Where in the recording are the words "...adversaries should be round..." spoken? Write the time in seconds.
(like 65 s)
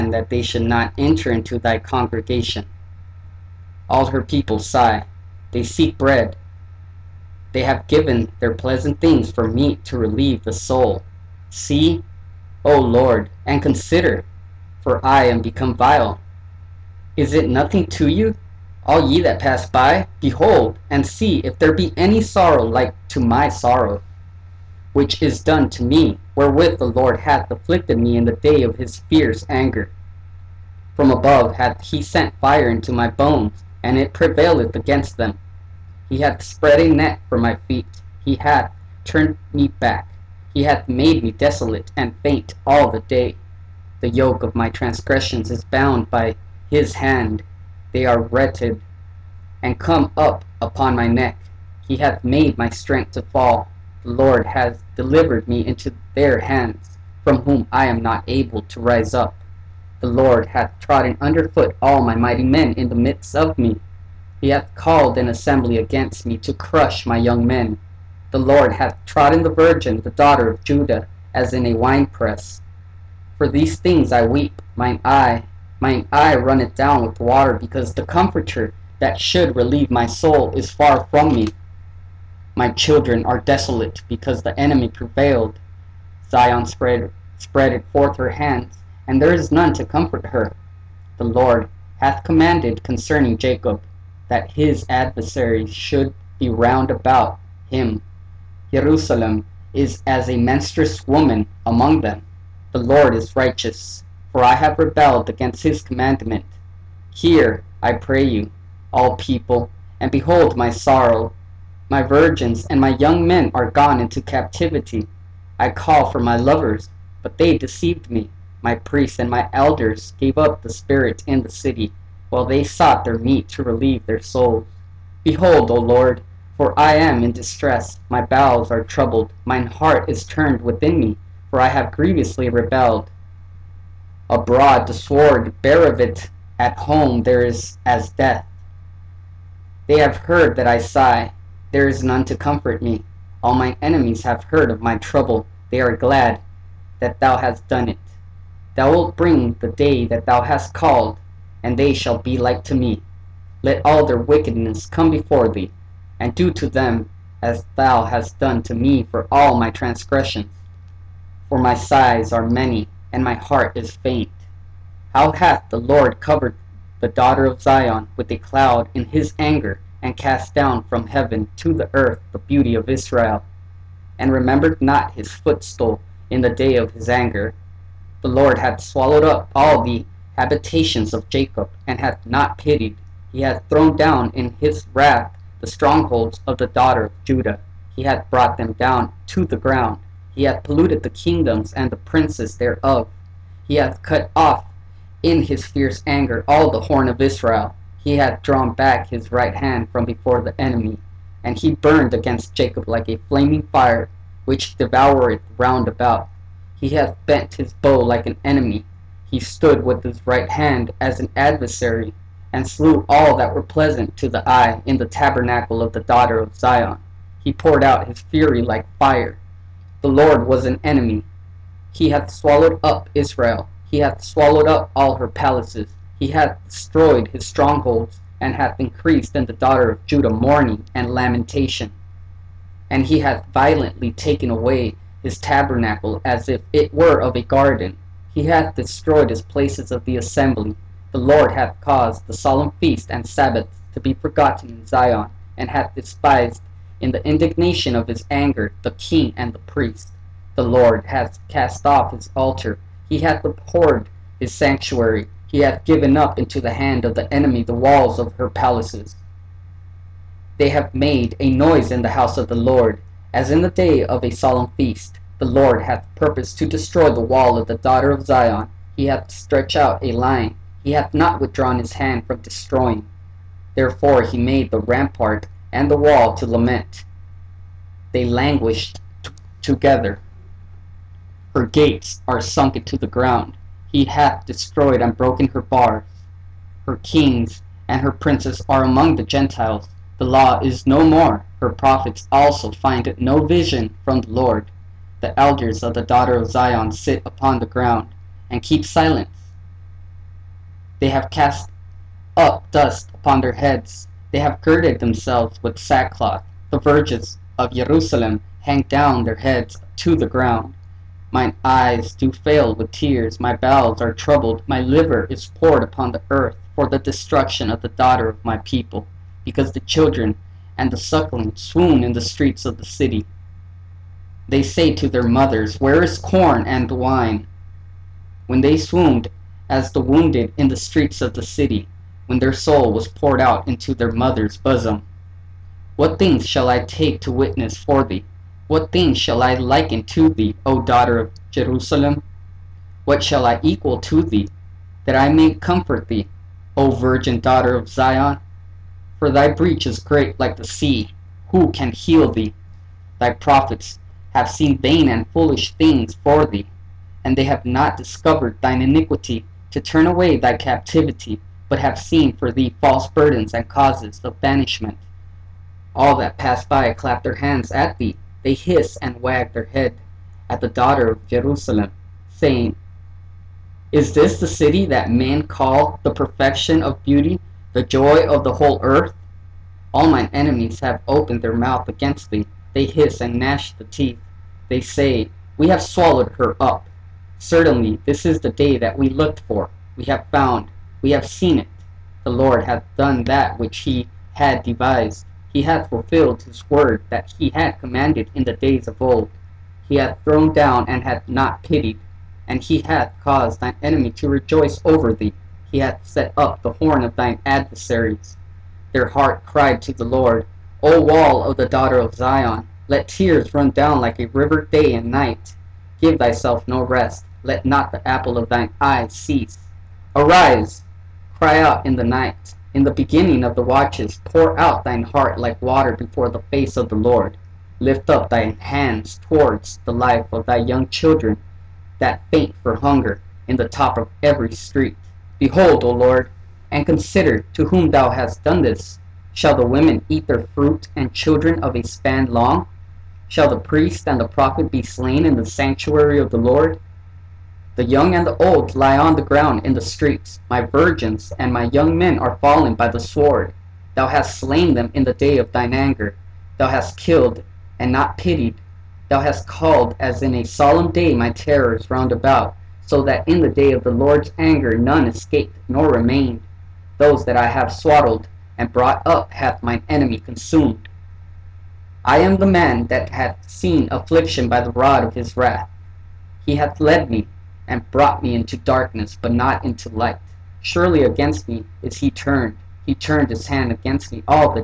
94 s.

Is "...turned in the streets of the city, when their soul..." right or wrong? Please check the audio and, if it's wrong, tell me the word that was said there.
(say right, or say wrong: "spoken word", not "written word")
wrong: "wounded", not "turned".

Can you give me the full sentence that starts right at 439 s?
Shall the women eat their fruit and children of a span long?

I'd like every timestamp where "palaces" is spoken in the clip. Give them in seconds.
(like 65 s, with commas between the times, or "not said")
225 s, 258 s.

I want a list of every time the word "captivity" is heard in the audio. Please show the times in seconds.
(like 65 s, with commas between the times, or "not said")
114 s, 360 s.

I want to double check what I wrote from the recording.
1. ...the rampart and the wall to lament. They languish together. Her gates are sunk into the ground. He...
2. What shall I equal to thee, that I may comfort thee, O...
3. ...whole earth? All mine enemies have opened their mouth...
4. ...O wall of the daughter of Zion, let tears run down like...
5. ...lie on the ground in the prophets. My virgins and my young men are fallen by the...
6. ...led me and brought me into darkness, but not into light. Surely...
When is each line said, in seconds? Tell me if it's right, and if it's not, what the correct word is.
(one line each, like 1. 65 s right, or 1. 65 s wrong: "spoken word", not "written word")
1. 274 s right
2. 343 s right
3. 378 s right
4. 410 s right
5. 448 s wrong: "streets", not "prophets"
6. 476 s right.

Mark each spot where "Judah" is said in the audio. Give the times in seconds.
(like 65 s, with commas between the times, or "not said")
70 s, 187 s, 230 s.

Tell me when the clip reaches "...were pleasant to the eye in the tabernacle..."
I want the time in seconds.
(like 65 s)
213 s.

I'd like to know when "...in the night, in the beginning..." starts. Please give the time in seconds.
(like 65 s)
421 s.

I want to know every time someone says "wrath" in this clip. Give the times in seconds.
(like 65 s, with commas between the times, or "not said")
184 s, 475 s.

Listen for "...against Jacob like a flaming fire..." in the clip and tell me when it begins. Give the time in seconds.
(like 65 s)
202 s.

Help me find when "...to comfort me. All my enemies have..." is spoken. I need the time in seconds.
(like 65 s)
142 s.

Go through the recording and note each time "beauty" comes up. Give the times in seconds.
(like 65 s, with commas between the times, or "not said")
172 s, 377 s.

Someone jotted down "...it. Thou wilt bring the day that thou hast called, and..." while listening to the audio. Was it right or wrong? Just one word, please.
right.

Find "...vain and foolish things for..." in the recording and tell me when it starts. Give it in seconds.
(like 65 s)
354 s.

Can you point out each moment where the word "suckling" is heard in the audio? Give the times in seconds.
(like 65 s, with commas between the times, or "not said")
320 s.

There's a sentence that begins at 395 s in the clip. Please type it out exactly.
He hath fulfilled his word that he had commanded in the days of old.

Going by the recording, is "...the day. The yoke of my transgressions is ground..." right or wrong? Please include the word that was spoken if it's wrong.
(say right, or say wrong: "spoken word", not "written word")
wrong: "bound", not "ground".